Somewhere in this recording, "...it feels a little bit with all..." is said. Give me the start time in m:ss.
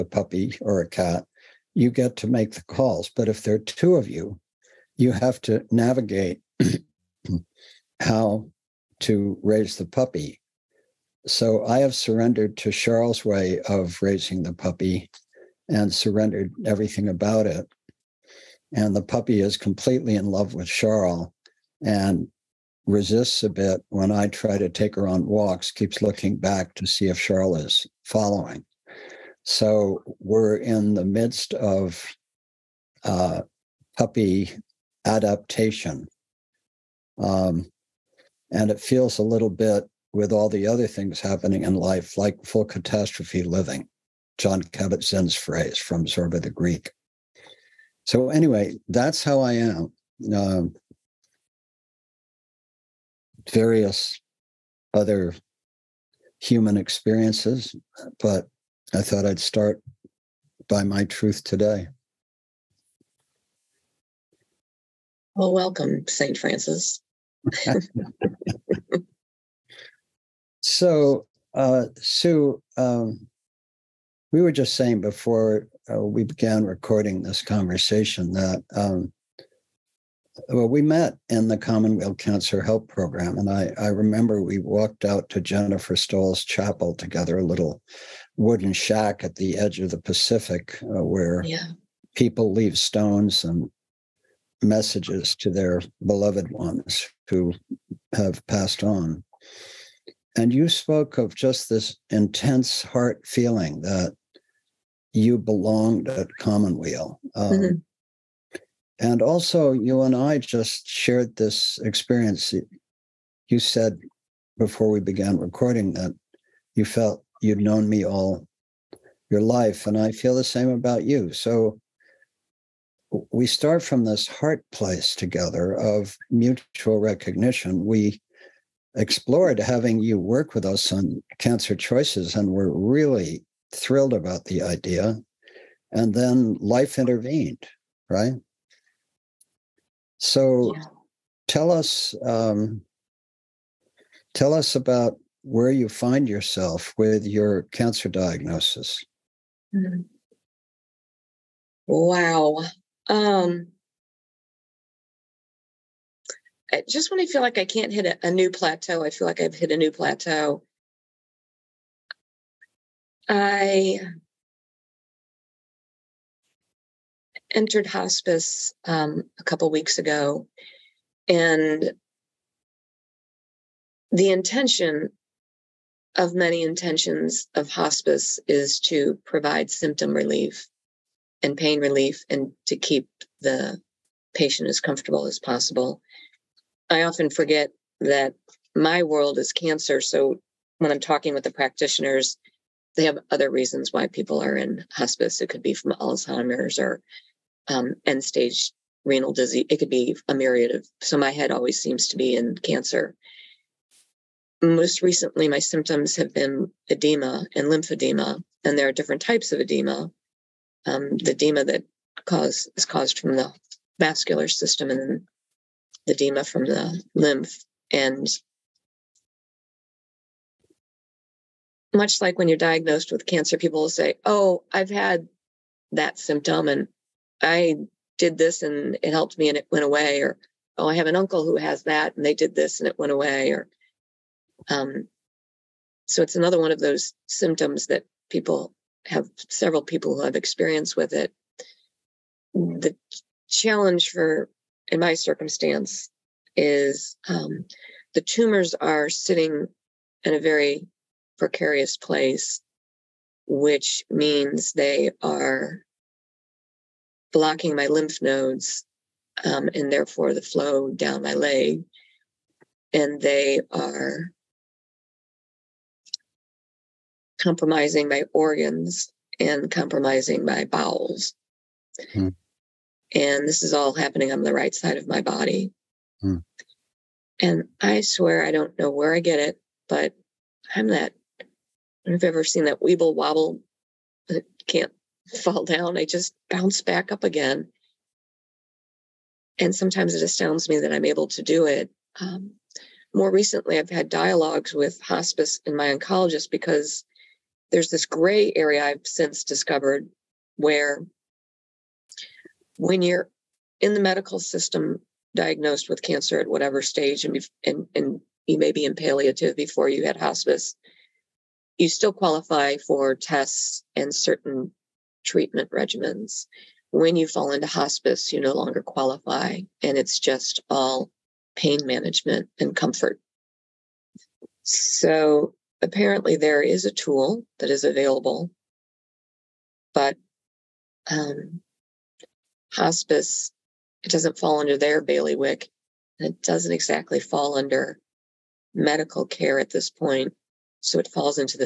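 0:38.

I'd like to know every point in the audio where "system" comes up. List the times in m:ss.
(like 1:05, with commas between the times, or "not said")
3:34, 5:04.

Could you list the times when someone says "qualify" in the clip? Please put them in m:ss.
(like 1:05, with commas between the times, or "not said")
5:12, 5:18.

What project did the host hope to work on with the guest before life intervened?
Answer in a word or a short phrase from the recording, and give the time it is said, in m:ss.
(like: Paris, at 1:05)
Cancer Choices, at 2:11.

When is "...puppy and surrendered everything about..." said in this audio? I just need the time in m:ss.
0:14.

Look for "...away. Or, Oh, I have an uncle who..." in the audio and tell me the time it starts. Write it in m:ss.
3:49.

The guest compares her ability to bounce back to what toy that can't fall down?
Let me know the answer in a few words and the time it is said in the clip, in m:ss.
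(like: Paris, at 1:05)
weeble wobble, at 4:42.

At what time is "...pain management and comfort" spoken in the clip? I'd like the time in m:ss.
5:21.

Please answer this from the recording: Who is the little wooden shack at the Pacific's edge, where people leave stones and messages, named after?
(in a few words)
Jennifer Stoll.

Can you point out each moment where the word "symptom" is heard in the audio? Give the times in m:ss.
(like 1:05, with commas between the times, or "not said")
2:59, 3:25, 3:46, 3:57.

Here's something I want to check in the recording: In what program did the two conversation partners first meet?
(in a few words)
Commonweal Cancer Help Program.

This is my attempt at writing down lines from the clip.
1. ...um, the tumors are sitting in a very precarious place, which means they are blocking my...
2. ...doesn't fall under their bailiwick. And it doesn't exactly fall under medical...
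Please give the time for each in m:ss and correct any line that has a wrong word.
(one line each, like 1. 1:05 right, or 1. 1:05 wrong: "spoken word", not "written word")
1. 4:07 right
2. 5:34 right.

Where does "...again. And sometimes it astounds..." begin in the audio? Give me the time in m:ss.
4:47.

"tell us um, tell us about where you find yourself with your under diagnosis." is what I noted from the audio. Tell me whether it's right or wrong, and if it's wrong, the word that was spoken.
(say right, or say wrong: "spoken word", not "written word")
wrong: "cancer", not "under".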